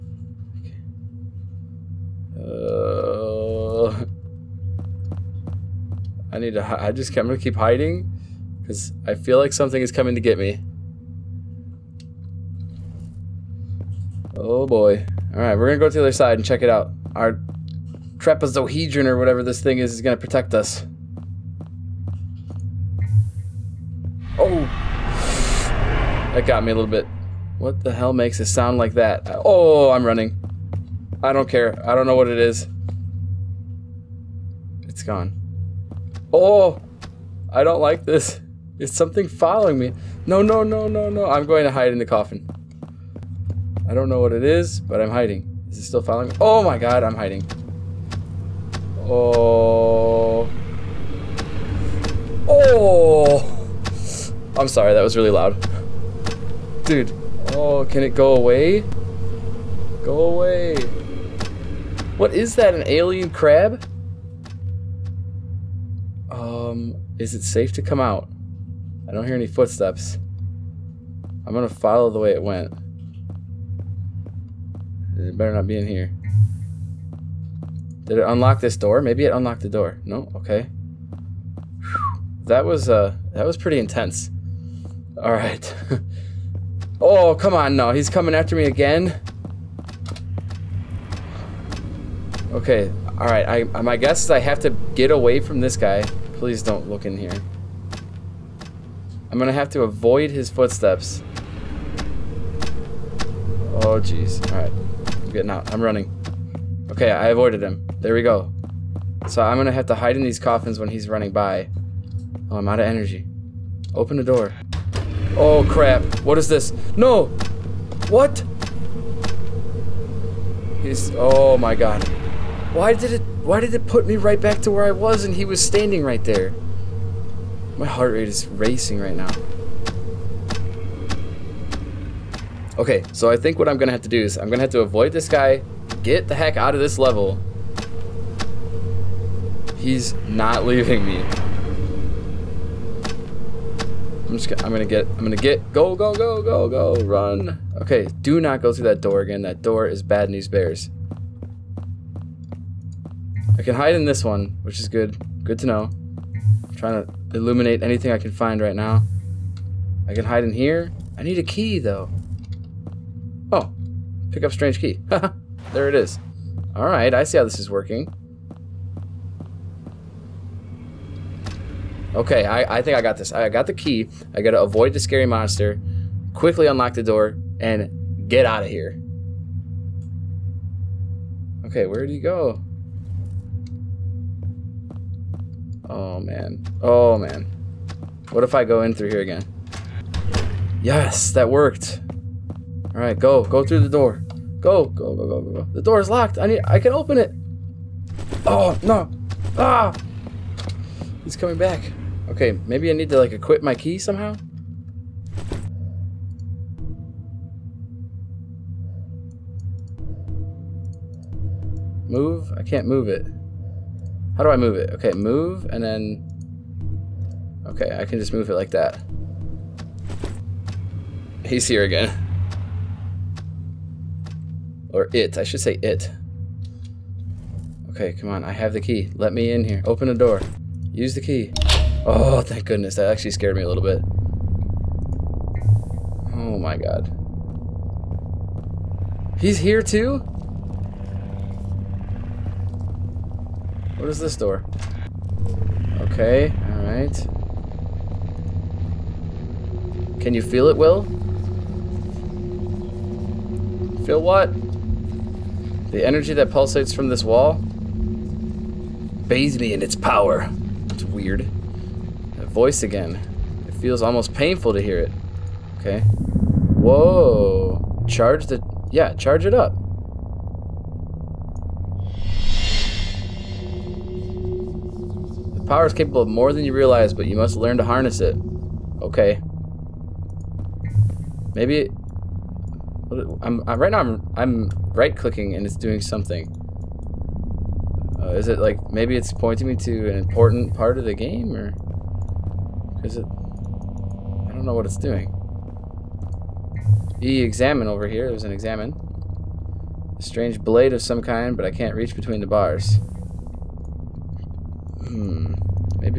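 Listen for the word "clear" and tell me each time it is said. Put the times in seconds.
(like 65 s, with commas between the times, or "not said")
not said.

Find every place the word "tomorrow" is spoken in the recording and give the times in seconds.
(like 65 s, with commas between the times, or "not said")
not said.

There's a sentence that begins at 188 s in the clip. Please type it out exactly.
What if I go in through here again?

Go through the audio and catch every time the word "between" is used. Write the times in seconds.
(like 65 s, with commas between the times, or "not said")
302 s.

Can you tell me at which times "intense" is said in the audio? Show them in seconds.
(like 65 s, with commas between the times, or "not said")
83 s.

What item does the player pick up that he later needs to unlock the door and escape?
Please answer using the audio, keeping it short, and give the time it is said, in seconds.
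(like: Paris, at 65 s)
strange key, at 164 s.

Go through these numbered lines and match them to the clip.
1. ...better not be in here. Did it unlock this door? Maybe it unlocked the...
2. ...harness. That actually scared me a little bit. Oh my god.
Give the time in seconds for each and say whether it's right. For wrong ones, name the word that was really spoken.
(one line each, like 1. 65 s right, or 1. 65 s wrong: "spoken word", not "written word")
1. 75 s right
2. 232 s wrong: "goodness", not "harness".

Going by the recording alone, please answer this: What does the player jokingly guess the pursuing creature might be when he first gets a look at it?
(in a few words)
an alien crab.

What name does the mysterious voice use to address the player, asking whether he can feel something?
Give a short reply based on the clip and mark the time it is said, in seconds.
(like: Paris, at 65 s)
Will, at 250 s.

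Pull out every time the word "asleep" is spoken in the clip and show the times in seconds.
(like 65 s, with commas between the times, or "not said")
not said.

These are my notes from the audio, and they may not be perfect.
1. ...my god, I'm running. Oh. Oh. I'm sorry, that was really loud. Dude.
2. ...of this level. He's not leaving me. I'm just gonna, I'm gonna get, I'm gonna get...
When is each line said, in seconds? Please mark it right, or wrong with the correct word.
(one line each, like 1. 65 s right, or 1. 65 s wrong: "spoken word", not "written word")
1. 46 s wrong: "hiding", not "running"
2. 136 s right.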